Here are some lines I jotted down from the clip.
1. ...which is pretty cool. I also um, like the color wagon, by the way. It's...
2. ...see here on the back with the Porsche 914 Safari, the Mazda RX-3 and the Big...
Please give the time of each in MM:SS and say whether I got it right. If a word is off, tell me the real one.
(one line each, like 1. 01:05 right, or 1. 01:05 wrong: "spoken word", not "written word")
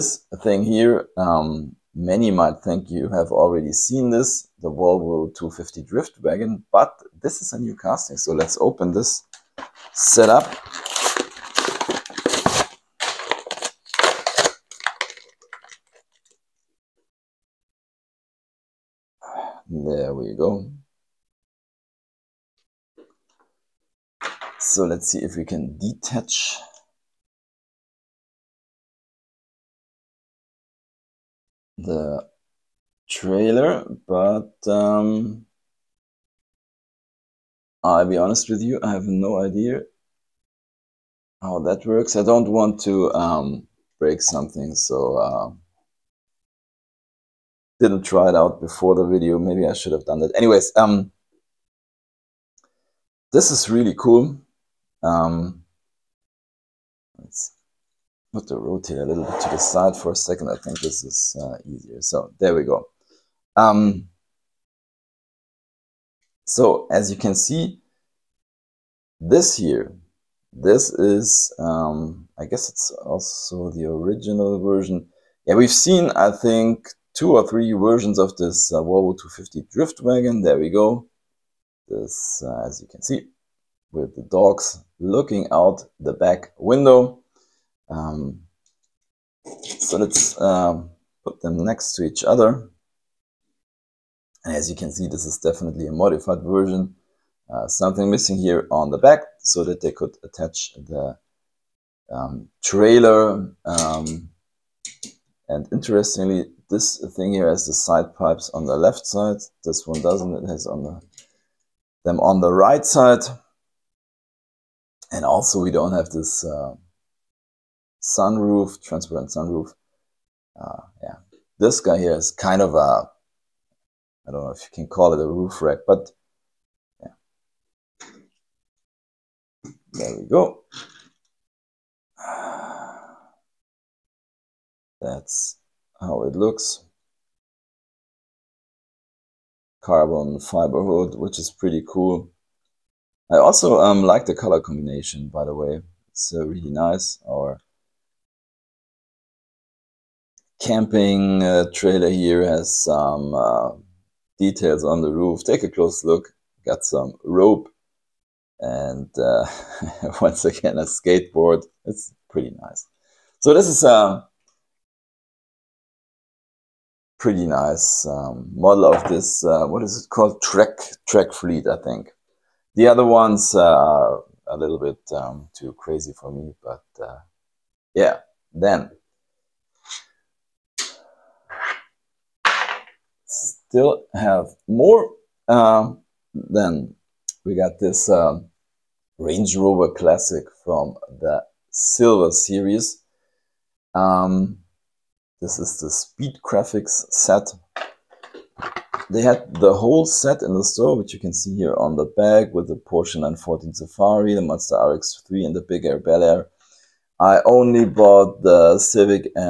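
1. 02:21 wrong: "combination", not "wagon"
2. 03:21 right.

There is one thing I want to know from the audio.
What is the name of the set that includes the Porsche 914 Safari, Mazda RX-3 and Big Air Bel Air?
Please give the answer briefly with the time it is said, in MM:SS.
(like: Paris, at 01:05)
Speed Graphics, at 03:15.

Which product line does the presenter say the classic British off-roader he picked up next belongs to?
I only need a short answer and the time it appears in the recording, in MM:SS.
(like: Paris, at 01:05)
Silver Series, at 03:11.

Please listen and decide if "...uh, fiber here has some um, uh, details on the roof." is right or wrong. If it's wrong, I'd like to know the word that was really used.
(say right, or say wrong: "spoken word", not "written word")
wrong: "trailer", not "fiber".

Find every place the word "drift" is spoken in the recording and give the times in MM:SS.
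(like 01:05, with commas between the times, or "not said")
00:05, 01:19.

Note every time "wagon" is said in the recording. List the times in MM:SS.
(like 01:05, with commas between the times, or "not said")
00:06, 01:20.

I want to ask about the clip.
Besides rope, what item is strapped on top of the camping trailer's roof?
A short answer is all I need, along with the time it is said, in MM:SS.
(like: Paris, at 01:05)
Skateboard, at 02:40.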